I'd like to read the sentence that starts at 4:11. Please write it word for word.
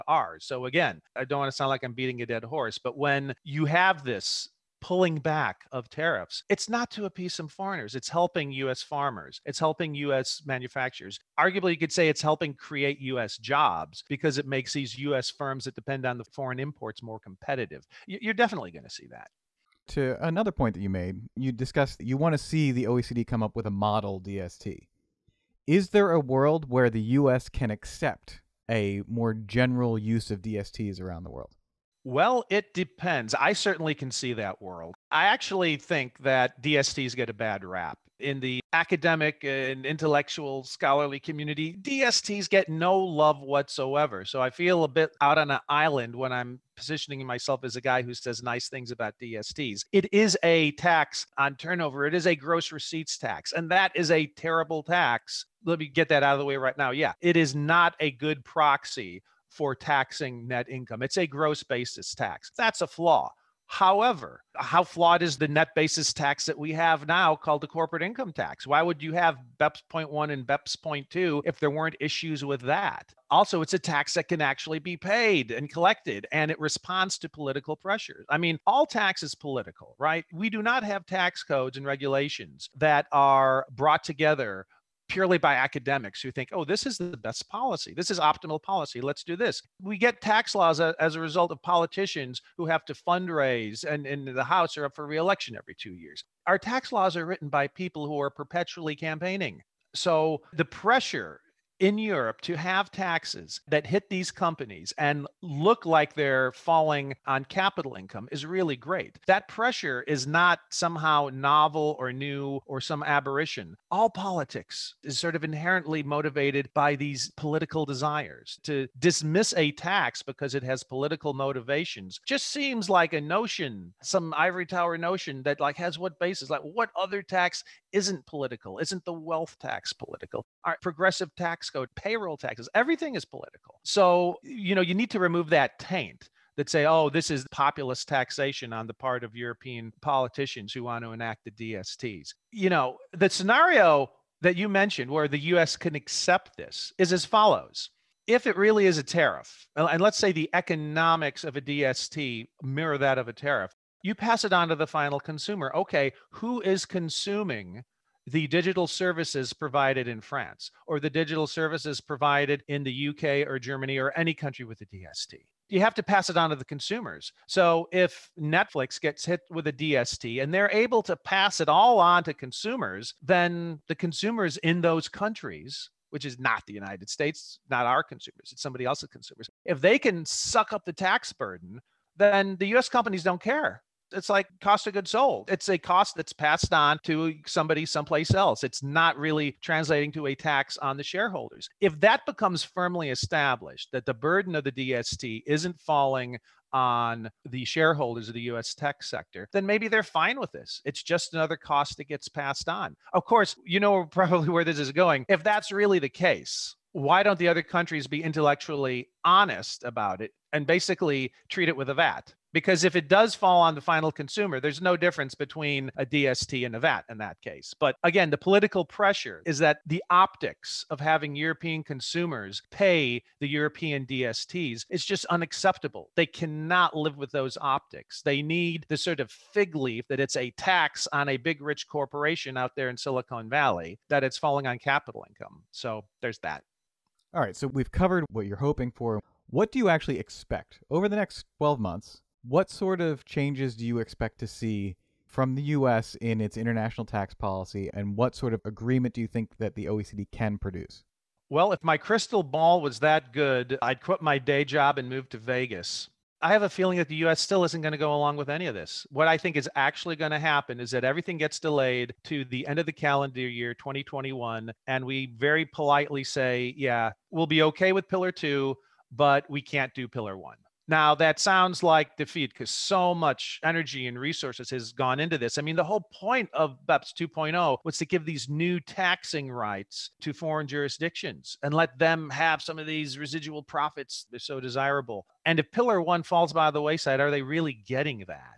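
Well, if my crystal ball was that good, I'd quit my day job and move to Vegas.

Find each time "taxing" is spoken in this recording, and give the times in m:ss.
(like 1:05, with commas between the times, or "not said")
0:59, 4:38.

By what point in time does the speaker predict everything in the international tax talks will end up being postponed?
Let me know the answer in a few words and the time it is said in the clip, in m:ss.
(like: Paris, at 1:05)
End of calendar year 2021, at 4:22.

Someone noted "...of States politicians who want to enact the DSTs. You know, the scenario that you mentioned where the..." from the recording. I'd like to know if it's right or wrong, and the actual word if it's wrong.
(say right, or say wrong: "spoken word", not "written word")
wrong: "European", not "States".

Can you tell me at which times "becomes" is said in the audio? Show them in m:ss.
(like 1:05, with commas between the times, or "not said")
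3:12.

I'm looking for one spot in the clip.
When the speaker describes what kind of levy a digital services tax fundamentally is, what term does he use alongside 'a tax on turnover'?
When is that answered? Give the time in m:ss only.
0:52.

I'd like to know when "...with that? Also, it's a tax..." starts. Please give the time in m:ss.
1:12.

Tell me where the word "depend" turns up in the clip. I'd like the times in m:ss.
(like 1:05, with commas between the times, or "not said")
0:15, 0:32.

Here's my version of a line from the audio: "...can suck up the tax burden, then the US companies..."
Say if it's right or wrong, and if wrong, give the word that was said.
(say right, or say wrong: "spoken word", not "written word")
right.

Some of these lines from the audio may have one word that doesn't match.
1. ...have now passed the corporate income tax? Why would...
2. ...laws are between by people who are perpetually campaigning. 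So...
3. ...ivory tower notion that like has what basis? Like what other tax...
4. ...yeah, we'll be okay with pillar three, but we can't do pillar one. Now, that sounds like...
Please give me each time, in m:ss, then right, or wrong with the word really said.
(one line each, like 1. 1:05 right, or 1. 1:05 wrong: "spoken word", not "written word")
1. 1:06 wrong: "called", not "passed"
2. 1:36 wrong: "written", not "between"
3. 2:04 right
4. 4:26 wrong: "two", not "three".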